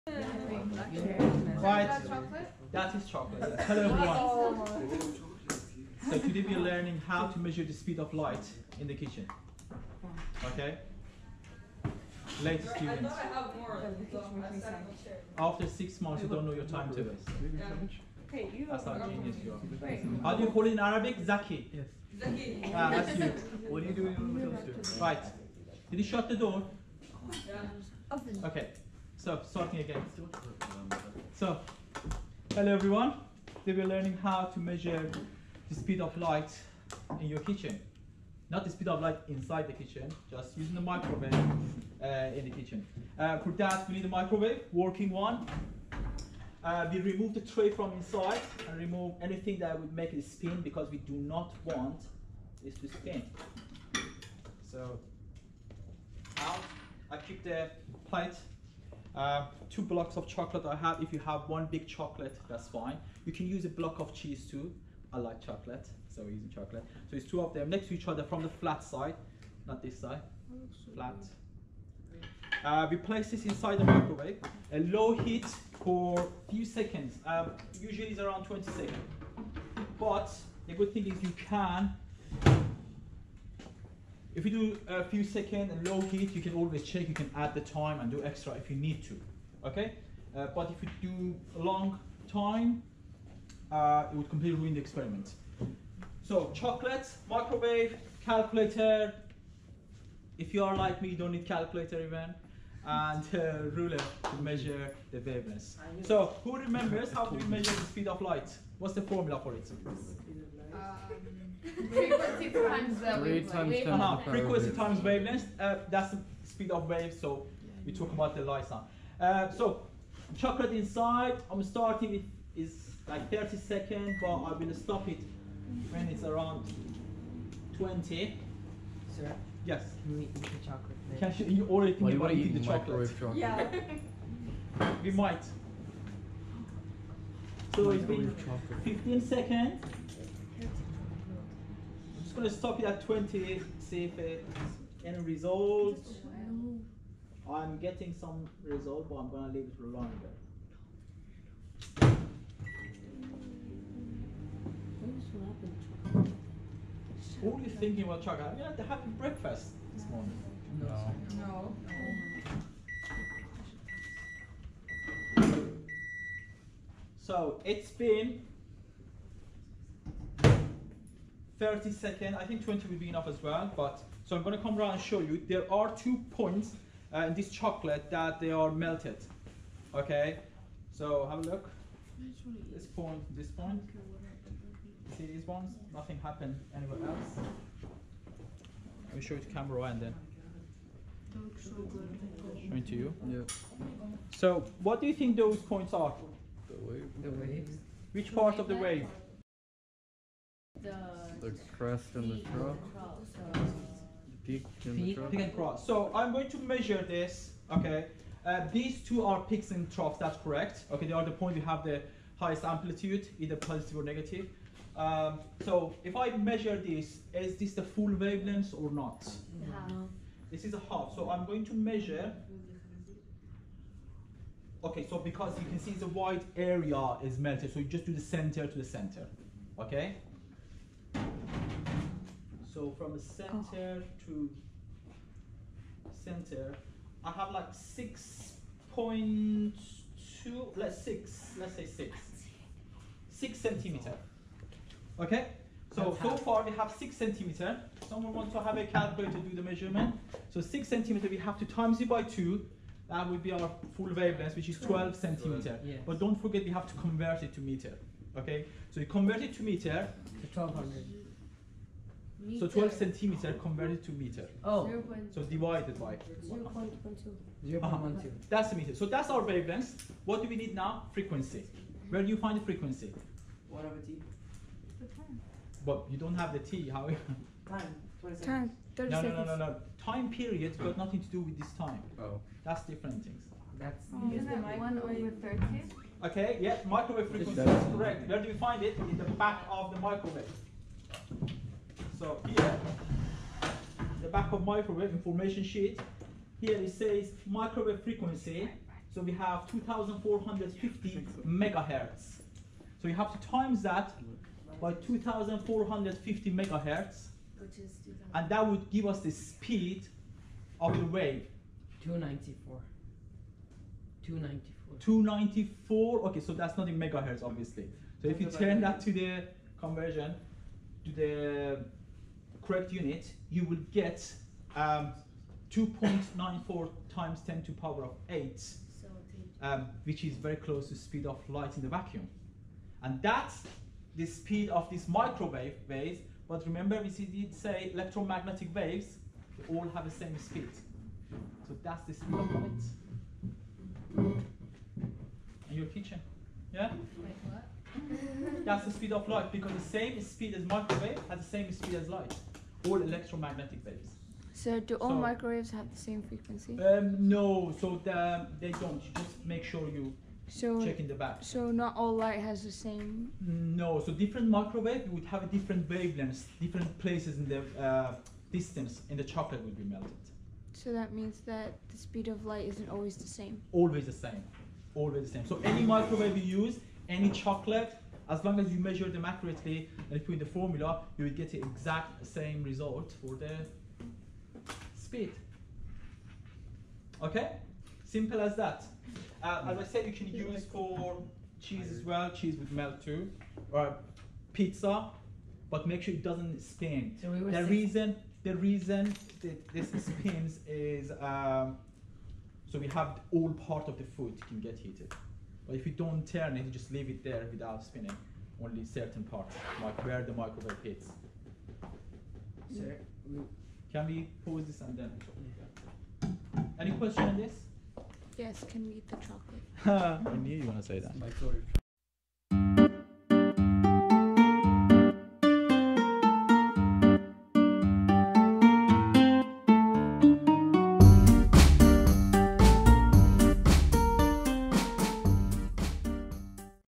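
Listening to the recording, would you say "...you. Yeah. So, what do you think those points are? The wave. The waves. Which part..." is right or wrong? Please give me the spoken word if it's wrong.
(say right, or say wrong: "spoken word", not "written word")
right.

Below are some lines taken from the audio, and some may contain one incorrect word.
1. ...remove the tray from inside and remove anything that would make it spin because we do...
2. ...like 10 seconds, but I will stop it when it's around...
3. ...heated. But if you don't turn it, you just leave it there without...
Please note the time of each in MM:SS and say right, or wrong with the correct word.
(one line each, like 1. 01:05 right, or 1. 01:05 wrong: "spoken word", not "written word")
1. 00:47 right
2. 02:03 wrong: "30", not "10"
3. 06:44 right.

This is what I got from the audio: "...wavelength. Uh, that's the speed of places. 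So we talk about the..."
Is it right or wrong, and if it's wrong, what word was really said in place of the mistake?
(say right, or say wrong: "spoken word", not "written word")
wrong: "waves", not "places".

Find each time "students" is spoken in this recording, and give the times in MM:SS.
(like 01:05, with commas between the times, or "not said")
00:12.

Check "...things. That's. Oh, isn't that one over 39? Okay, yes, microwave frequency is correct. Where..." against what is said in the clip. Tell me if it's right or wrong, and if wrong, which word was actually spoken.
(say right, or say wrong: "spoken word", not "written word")
wrong: "30", not "39".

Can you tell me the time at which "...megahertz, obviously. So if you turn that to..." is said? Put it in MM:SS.
05:16.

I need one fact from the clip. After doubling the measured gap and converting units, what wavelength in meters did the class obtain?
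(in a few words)
0.12 meters.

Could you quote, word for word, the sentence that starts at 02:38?
Have you had to have breakfast this morning?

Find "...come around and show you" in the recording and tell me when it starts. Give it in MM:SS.
02:54.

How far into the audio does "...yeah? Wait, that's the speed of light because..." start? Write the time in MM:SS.
05:46.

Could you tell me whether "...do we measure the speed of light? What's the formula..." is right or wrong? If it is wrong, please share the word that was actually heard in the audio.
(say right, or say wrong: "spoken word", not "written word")
right.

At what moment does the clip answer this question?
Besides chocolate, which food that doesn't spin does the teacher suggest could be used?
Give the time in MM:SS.
06:33.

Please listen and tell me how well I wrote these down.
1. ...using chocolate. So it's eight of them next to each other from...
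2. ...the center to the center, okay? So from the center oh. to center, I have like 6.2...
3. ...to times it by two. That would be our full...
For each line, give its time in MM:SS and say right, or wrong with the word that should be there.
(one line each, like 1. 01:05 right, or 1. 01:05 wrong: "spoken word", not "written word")
1. 01:06 wrong: "two", not "eight"
2. 03:48 right
3. 04:11 right.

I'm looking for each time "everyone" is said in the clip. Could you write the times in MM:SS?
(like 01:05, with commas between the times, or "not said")
00:03, 00:32.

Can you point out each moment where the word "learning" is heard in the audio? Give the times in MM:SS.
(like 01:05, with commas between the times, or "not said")
00:06, 00:33.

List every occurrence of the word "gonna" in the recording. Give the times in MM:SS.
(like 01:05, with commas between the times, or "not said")
02:22, 02:29.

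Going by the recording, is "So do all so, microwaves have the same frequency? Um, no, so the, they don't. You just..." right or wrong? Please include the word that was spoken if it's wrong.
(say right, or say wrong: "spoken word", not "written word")
right.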